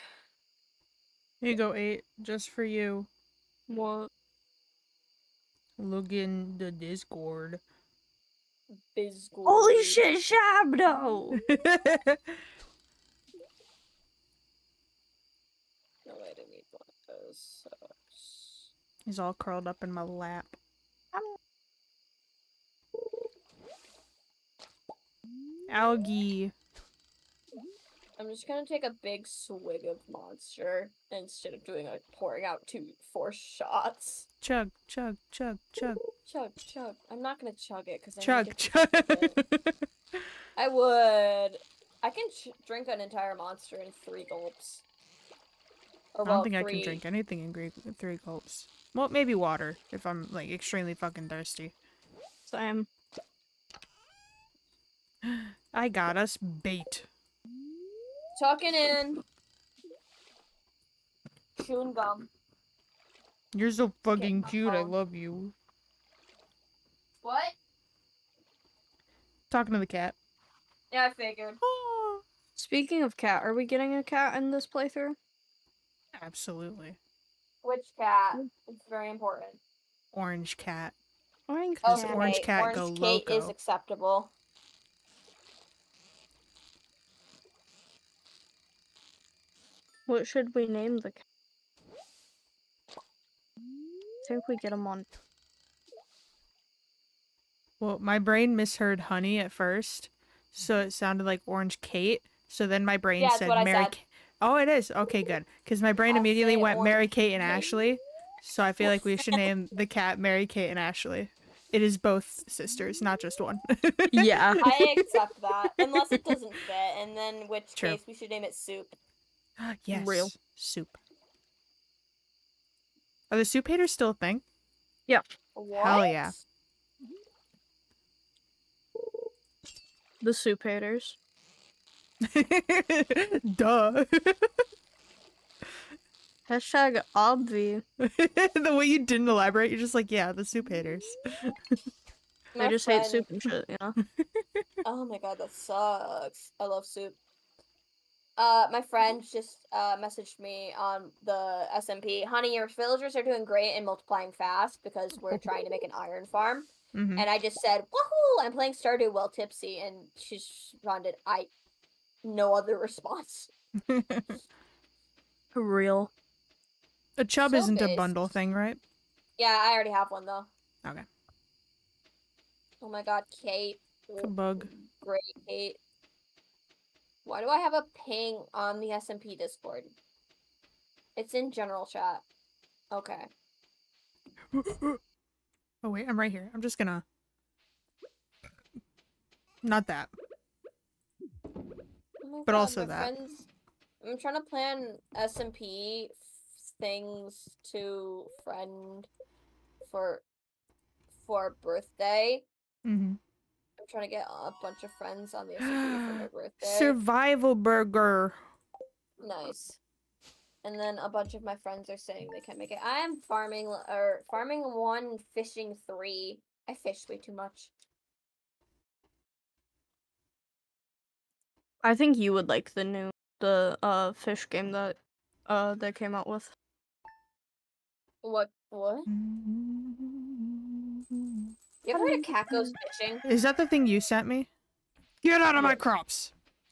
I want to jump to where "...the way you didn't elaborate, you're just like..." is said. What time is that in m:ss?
2:17.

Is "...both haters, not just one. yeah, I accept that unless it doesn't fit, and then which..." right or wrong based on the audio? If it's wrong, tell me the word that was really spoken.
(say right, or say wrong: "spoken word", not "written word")
wrong: "sisters", not "haters".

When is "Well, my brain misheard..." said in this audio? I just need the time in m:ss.
1:37.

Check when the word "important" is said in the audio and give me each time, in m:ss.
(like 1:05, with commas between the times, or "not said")
1:19.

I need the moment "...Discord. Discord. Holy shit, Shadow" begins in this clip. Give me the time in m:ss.
0:06.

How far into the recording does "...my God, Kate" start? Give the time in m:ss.
2:52.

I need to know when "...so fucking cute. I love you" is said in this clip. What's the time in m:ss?
1:03.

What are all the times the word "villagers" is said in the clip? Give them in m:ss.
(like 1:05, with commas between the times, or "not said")
2:32.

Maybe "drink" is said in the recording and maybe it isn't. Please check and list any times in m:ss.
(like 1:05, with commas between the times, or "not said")
0:42, 0:46.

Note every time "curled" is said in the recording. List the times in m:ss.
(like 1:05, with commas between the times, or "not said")
0:19.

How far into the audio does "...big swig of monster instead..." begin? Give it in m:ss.
0:29.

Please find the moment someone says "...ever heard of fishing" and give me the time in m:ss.
3:51.